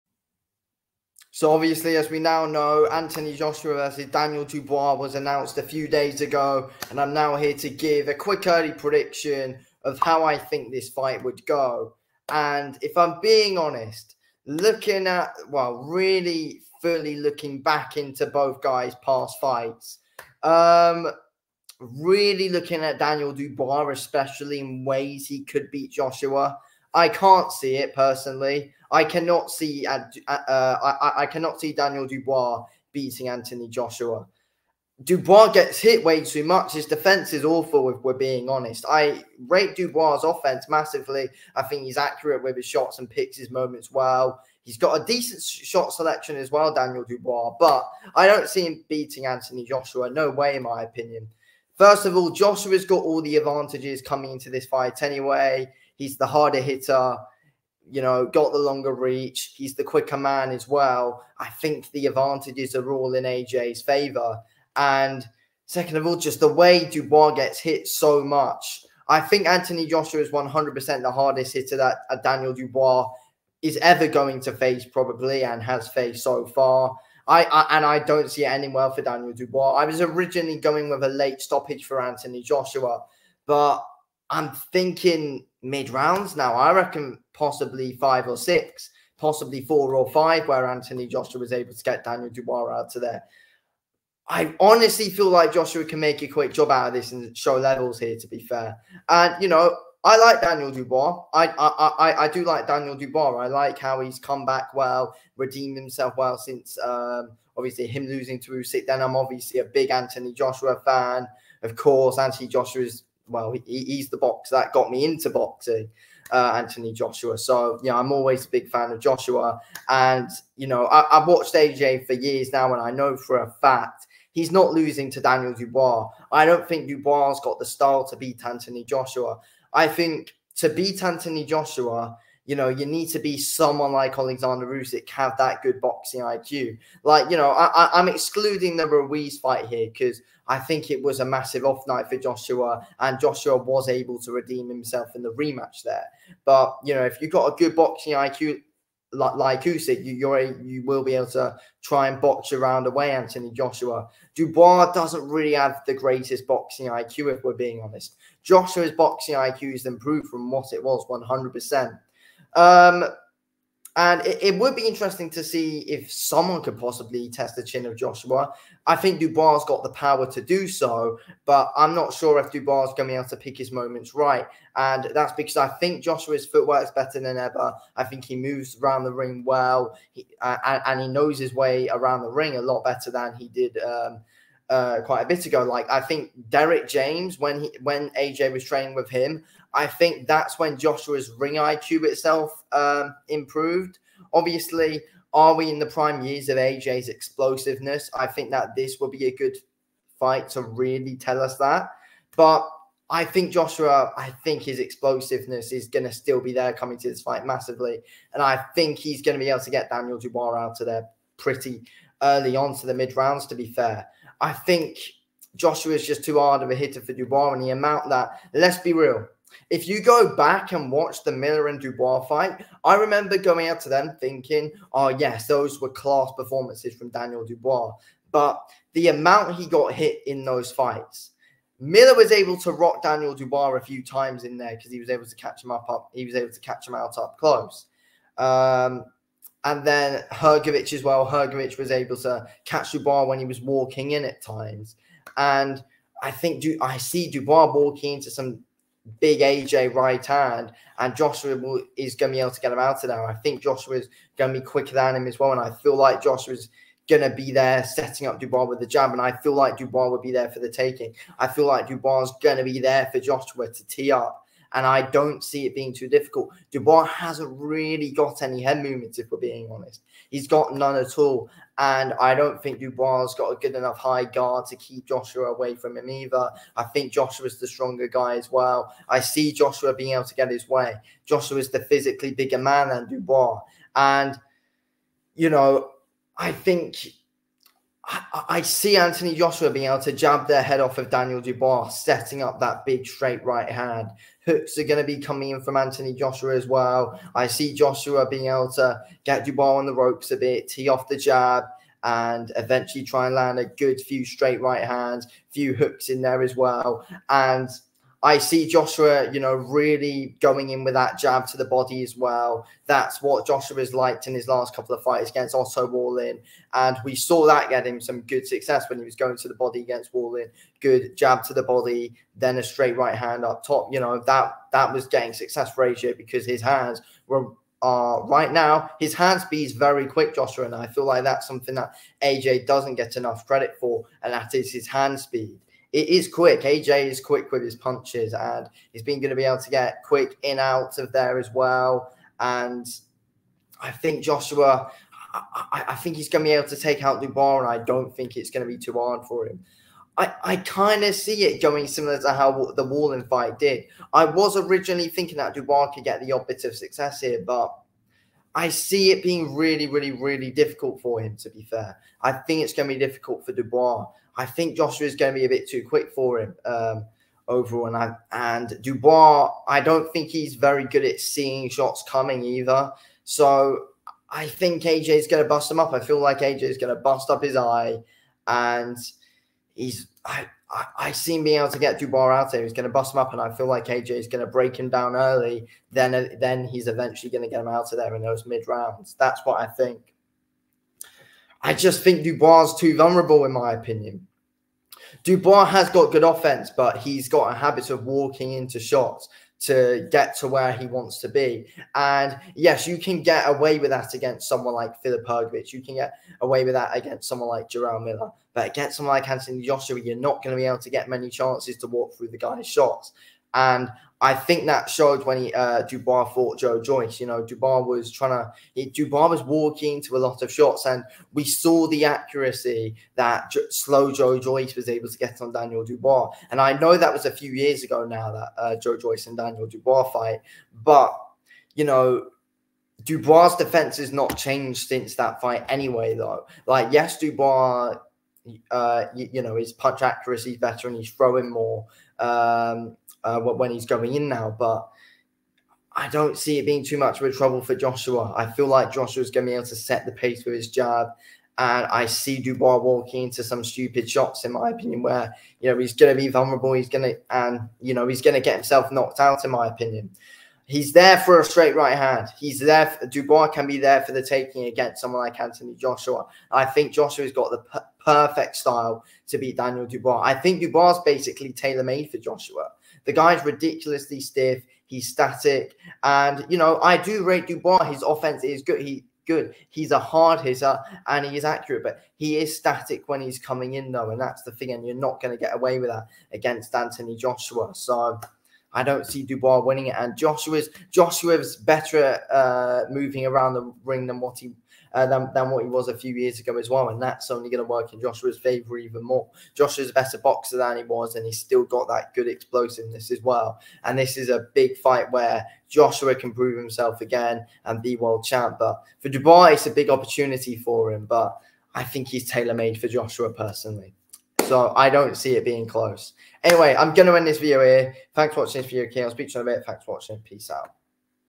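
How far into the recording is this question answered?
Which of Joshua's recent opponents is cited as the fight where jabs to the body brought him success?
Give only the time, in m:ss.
5:15.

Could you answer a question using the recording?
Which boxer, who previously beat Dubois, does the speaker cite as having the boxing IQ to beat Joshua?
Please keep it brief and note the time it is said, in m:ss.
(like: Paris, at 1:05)
Alexander Usyk, at 2:14.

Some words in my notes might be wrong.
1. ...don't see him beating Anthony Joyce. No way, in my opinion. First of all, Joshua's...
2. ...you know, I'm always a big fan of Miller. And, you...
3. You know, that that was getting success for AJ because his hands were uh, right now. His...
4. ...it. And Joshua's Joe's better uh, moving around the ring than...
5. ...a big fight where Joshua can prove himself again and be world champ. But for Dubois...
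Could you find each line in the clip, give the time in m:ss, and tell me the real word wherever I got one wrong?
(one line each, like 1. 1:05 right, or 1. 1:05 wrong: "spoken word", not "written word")
1. 0:48 wrong: "Joshua", not "Joyce"
2. 1:57 wrong: "Joshua", not "Miller"
3. 5:23 right
4. 8:09 wrong: "Joshua", not "Joe"
5. 8:24 right.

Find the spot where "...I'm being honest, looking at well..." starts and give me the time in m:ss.
0:12.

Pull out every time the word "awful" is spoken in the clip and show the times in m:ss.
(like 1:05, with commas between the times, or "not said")
0:37.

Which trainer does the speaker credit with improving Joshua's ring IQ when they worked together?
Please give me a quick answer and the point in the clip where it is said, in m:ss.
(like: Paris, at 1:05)
Derrick James, at 3:06.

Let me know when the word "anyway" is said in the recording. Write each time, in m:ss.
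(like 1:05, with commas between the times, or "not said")
0:55, 7:15, 8:36.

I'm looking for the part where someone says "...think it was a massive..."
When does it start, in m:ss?
2:20.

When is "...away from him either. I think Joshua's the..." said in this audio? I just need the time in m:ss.
4:35.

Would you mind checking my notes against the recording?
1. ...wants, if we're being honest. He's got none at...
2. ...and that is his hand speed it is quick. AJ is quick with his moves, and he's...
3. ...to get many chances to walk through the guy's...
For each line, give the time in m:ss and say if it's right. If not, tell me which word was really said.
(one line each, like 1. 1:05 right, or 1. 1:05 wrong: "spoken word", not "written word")
1. 4:28 wrong: "movements", not "wants"
2. 5:34 wrong: "punches", not "moves"
3. 6:50 right.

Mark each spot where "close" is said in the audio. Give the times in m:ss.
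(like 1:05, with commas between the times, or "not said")
3:57, 8:35.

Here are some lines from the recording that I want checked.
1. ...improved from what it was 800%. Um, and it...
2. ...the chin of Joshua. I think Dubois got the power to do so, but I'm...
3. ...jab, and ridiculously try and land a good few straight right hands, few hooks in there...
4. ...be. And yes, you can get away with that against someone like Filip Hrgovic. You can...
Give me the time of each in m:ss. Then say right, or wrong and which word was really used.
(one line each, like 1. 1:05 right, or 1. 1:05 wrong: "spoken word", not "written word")
1. 2:39 wrong: "100", not "800"
2. 2:47 right
3. 5:01 wrong: "eventually", not "ridiculously"
4. 6:41 right.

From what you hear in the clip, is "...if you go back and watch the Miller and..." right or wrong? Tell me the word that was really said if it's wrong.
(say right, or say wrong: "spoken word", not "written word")
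right.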